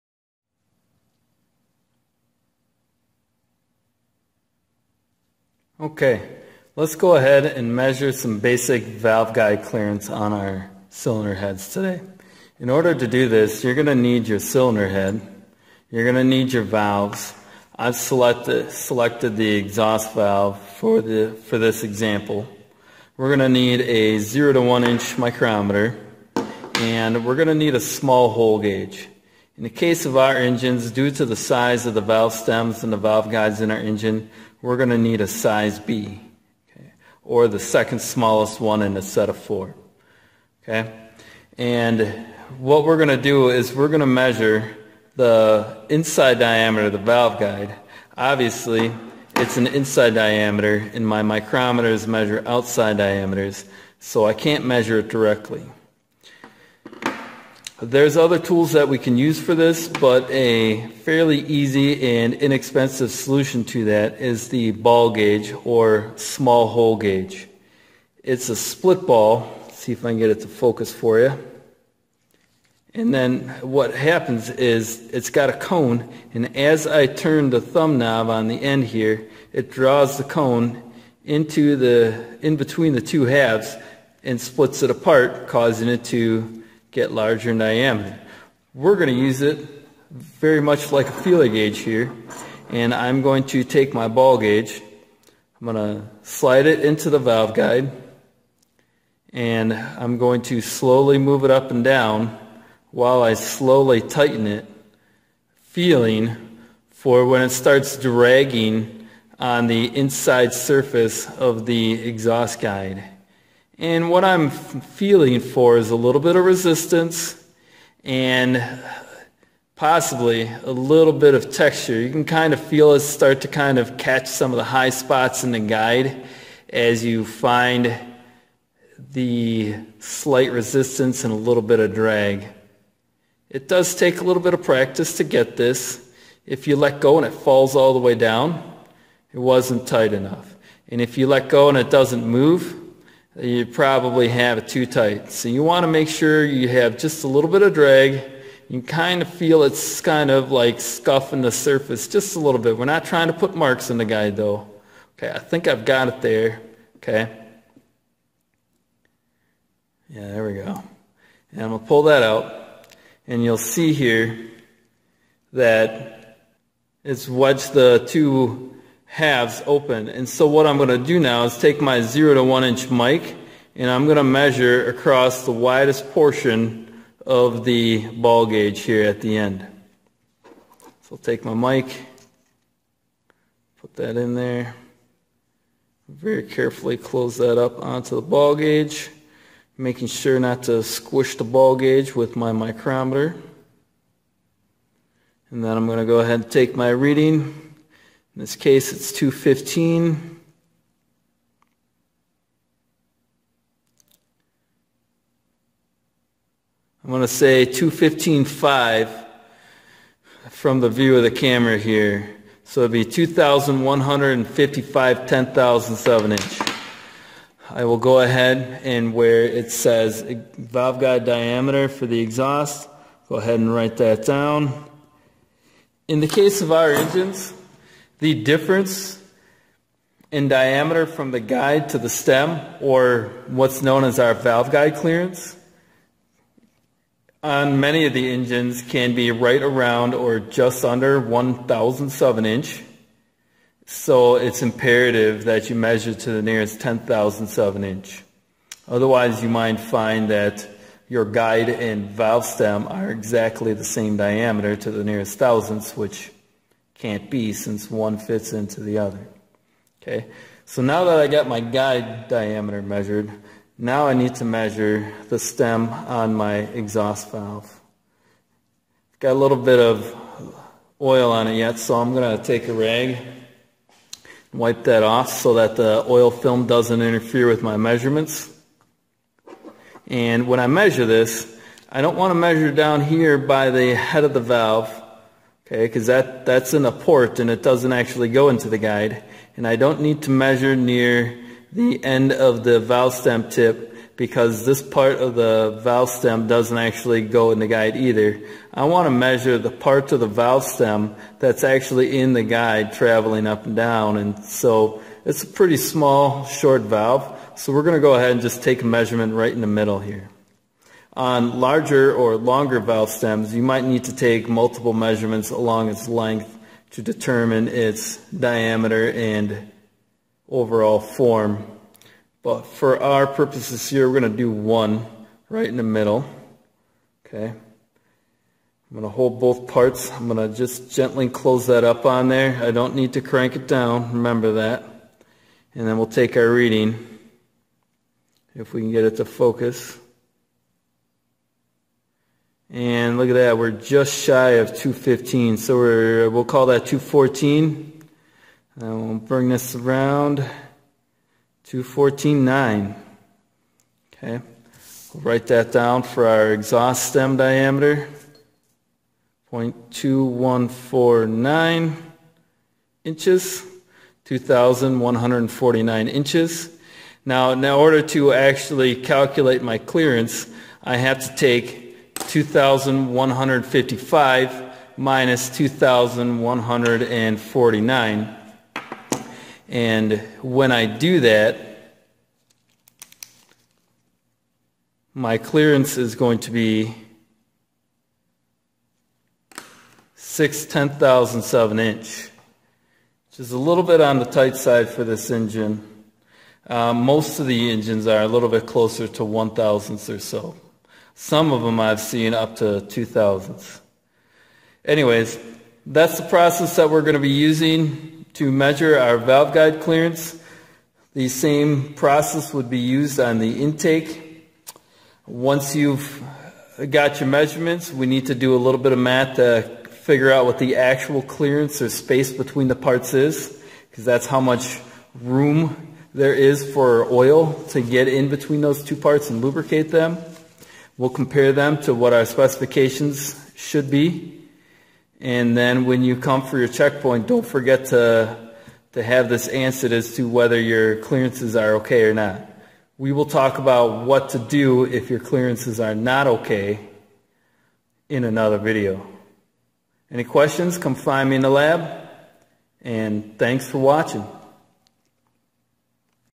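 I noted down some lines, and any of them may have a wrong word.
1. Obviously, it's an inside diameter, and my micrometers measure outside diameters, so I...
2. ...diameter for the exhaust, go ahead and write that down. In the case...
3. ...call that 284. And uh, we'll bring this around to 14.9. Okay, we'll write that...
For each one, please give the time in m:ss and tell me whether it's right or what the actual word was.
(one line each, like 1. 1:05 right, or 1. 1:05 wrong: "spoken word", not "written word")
1. 0:48 right
2. 3:41 right
3. 5:46 wrong: "214", not "284".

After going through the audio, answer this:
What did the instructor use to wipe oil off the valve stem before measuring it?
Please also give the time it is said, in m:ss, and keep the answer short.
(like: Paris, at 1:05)
A rag, at 4:32.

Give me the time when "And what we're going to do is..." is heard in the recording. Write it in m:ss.
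0:41.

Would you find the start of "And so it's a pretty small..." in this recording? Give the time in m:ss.
5:04.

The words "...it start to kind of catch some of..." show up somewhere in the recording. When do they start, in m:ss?
2:02.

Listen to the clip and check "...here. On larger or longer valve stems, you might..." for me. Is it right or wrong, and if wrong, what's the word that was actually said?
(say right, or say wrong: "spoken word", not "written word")
right.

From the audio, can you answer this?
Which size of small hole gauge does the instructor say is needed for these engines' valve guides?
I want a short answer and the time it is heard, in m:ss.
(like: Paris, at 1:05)
Size B, at 0:35.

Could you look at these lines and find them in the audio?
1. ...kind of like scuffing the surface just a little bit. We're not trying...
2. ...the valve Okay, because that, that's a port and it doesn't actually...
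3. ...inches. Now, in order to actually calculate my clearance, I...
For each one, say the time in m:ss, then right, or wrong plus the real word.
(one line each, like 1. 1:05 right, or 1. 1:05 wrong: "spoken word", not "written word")
1. 2:30 right
2. 4:44 right
3. 6:06 right.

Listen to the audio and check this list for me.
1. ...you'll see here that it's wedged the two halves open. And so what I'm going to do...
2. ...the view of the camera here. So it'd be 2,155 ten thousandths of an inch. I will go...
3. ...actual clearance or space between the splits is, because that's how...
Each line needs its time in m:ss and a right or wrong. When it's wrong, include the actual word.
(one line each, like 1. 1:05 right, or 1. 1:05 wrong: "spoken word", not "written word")
1. 2:43 right
2. 3:30 right
3. 7:00 wrong: "parts", not "splits".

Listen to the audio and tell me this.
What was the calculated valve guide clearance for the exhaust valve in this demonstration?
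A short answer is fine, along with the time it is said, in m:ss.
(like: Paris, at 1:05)
6 ten-thousandths inch, at 6:30.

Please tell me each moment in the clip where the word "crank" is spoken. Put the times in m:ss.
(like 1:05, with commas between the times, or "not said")
5:33.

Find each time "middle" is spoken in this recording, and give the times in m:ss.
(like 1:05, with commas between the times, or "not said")
5:09, 5:25.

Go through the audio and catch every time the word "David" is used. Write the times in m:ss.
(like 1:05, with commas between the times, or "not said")
not said.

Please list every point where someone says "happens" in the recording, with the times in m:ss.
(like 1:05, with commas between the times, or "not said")
1:13.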